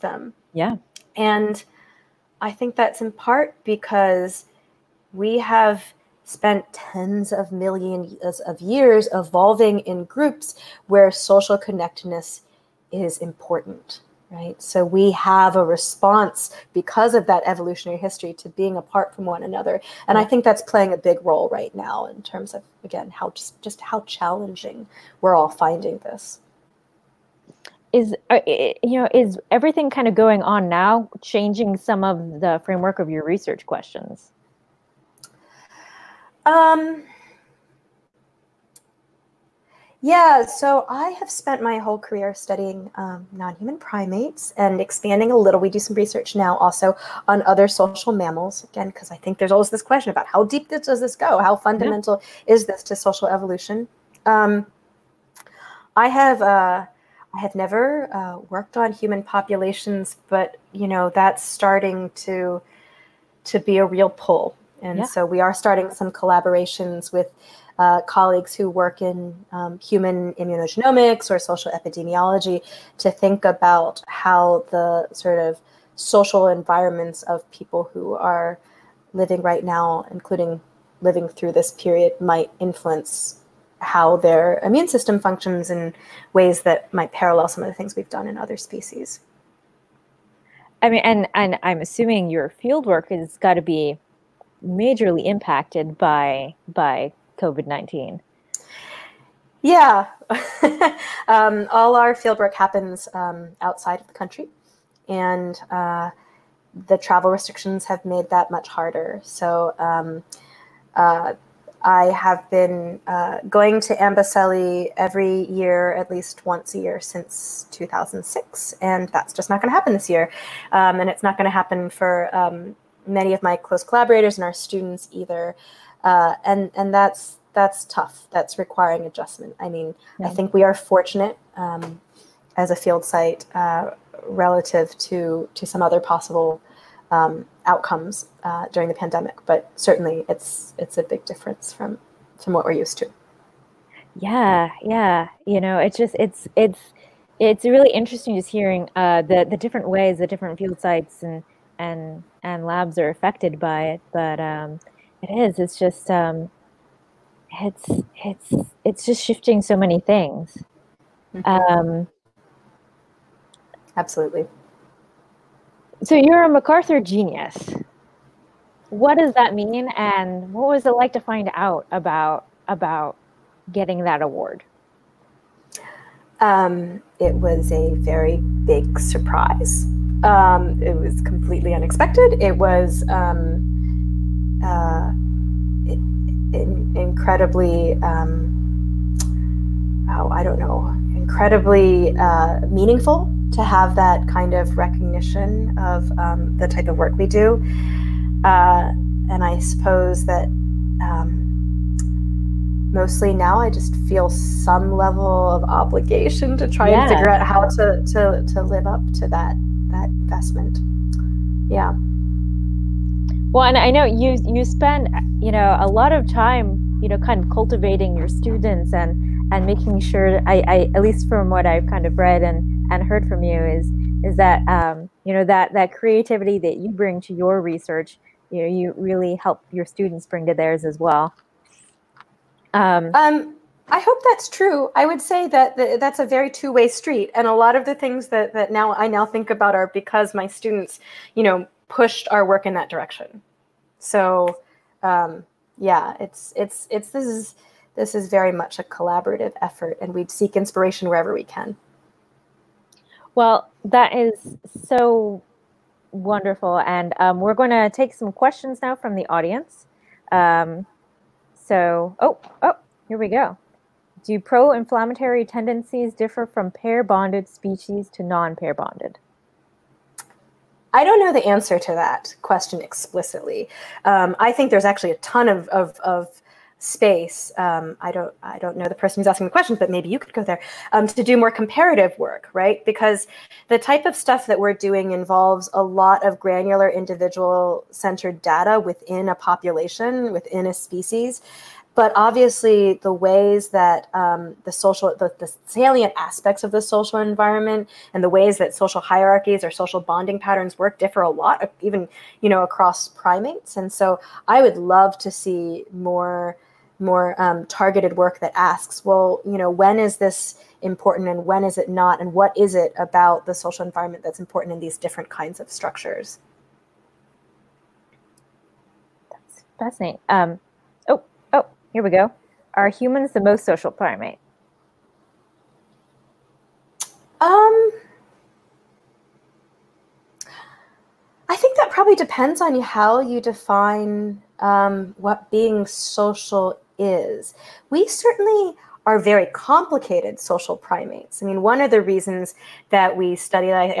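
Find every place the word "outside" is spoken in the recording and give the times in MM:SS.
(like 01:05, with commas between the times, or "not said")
01:43.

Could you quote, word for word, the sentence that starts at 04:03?
So, um, yeah, it's it's it's this is this is very much a collaborative effort, and we seek inspiration wherever we can.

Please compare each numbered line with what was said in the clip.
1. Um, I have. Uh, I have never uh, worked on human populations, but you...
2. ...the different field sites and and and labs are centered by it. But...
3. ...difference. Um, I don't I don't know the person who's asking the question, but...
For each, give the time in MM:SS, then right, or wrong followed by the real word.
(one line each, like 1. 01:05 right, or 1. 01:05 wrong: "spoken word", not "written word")
1. 00:54 right
2. 02:30 wrong: "affected", not "centered"
3. 04:36 wrong: "space", not "difference".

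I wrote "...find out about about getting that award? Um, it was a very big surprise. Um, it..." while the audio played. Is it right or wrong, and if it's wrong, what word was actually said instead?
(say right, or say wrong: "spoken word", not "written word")
right.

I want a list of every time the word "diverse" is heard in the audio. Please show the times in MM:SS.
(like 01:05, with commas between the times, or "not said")
not said.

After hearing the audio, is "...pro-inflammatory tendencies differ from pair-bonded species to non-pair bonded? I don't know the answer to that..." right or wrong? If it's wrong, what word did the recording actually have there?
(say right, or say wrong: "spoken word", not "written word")
right.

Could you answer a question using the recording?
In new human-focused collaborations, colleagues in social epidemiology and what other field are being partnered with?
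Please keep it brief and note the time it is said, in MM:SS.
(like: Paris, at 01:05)
Human immunogenomics, at 01:09.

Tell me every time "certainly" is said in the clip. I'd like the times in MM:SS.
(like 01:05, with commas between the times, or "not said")
02:19, 05:38.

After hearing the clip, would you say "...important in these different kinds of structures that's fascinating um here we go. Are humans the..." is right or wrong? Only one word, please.
right.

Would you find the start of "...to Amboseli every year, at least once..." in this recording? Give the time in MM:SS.
01:53.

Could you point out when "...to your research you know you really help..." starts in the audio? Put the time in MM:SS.
03:47.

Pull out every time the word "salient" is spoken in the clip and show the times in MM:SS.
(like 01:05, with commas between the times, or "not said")
04:55.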